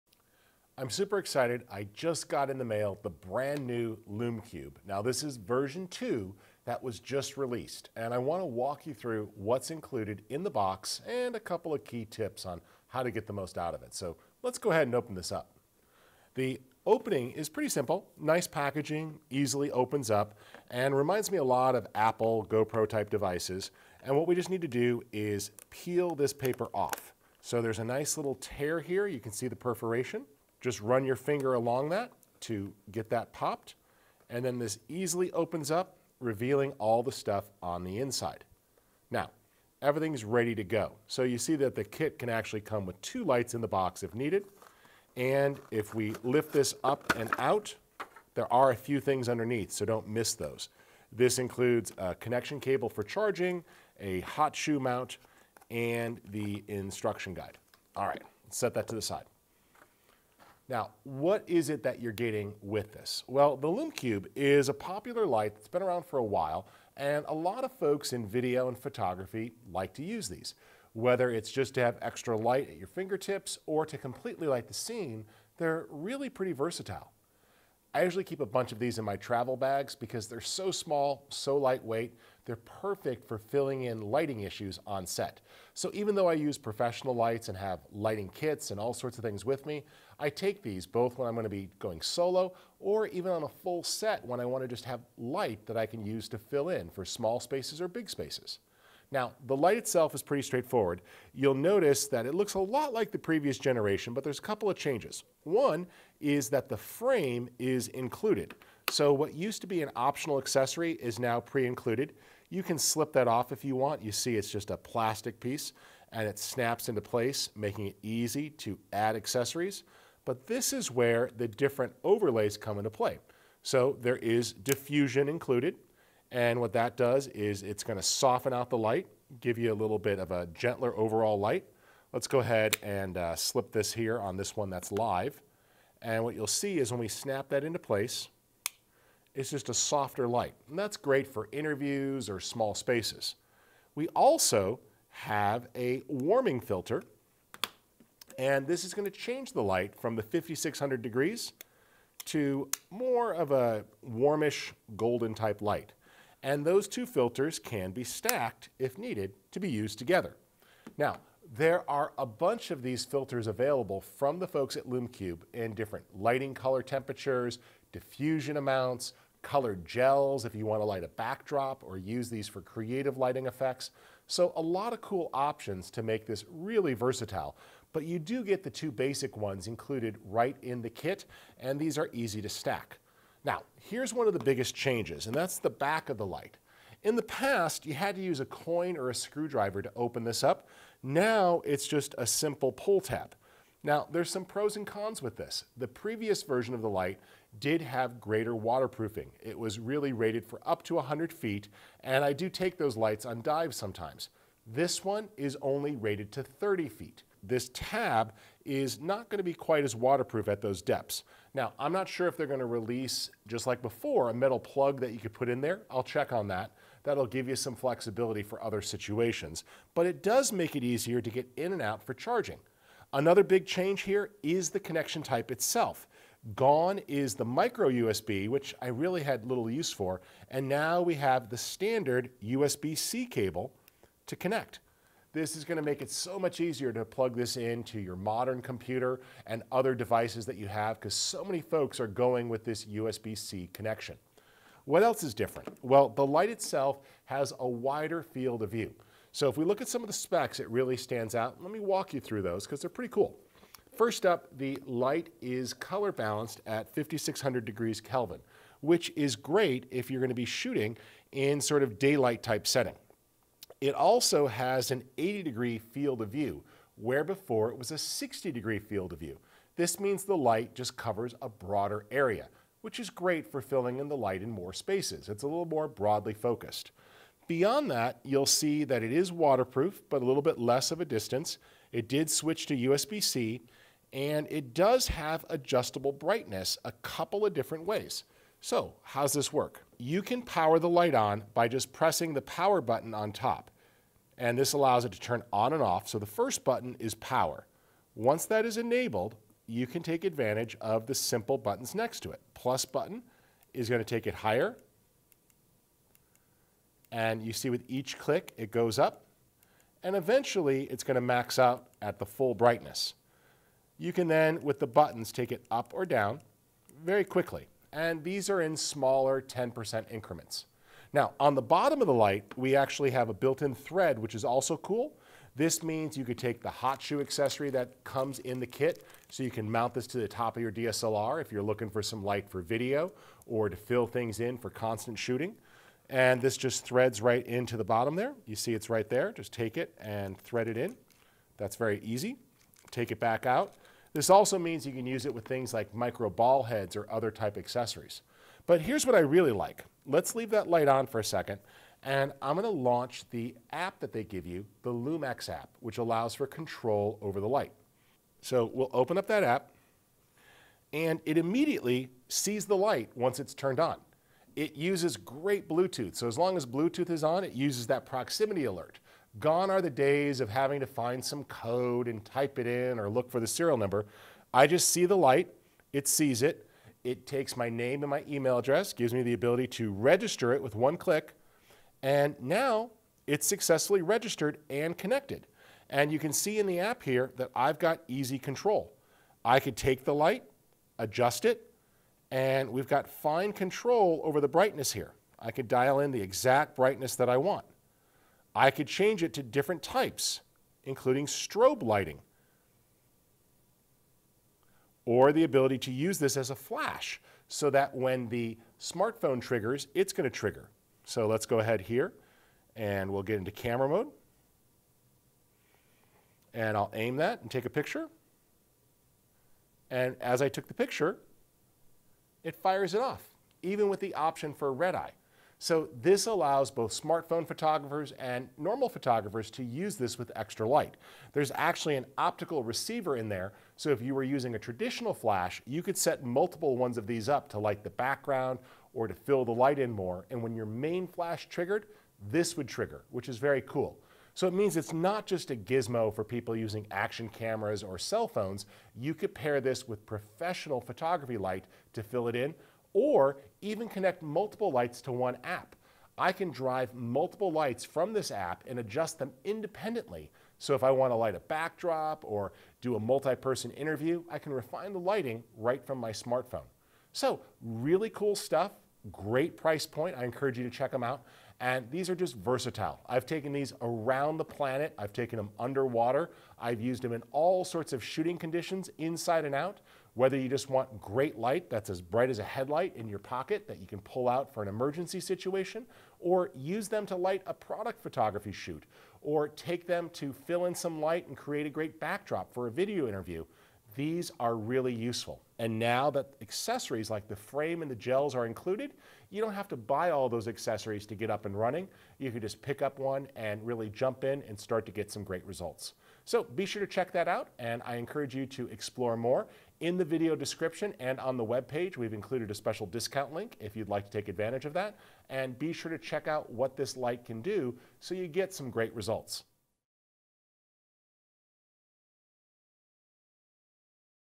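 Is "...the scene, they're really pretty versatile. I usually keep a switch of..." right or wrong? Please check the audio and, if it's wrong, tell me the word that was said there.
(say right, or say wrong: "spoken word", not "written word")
wrong: "bunch", not "switch".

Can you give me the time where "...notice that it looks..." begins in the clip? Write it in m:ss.
1:41.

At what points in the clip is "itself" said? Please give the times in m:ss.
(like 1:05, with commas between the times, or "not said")
1:39, 3:45, 4:06.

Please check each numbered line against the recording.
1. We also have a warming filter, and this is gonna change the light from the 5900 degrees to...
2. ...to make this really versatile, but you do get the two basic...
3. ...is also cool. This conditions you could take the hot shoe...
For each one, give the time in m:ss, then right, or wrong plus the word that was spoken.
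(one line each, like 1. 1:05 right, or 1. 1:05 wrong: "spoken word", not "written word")
1. 2:23 wrong: "5600", not "5900"
2. 2:55 right
3. 5:24 wrong: "means", not "conditions".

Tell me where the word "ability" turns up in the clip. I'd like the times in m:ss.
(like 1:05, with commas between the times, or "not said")
6:19, 6:45.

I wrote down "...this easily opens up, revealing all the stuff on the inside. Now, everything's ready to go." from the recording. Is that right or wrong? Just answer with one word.
right.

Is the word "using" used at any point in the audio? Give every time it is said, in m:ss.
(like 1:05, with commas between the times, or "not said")
7:14, 7:26.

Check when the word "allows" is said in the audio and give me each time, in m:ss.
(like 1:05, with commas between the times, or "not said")
4:54, 5:55, 7:06.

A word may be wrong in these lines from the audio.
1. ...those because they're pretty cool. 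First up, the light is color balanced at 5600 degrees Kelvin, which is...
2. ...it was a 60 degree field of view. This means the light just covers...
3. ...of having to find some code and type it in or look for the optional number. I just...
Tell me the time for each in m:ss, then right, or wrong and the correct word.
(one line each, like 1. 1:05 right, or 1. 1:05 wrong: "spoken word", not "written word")
1. 4:12 right
2. 4:27 right
3. 6:10 wrong: "serial", not "optional".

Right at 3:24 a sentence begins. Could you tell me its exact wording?
This one is only rated to 30 feet.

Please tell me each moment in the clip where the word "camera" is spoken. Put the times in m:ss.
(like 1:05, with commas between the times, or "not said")
6:53, 7:27.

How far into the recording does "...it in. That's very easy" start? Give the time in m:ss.
5:40.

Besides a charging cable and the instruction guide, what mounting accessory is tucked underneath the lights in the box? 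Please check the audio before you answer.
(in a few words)
hot shoe mount.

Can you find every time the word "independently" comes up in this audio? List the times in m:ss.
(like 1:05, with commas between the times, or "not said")
7:39.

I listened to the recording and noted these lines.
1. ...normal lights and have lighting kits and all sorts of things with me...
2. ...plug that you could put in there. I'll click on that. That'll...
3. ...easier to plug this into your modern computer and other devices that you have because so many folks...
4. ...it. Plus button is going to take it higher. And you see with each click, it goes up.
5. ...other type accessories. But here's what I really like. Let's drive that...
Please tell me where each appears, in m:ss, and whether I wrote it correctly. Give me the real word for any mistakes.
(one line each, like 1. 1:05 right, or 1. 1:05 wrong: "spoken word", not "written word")
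1. 1:26 wrong: "professional", not "normal"
2. 3:34 wrong: "check", not "click"
3. 3:56 right
4. 5:02 right
5. 5:47 wrong: "leave", not "drive".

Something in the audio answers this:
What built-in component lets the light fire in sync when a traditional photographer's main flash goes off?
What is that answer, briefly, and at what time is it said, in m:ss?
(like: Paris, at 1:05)
optical receiver, at 7:12.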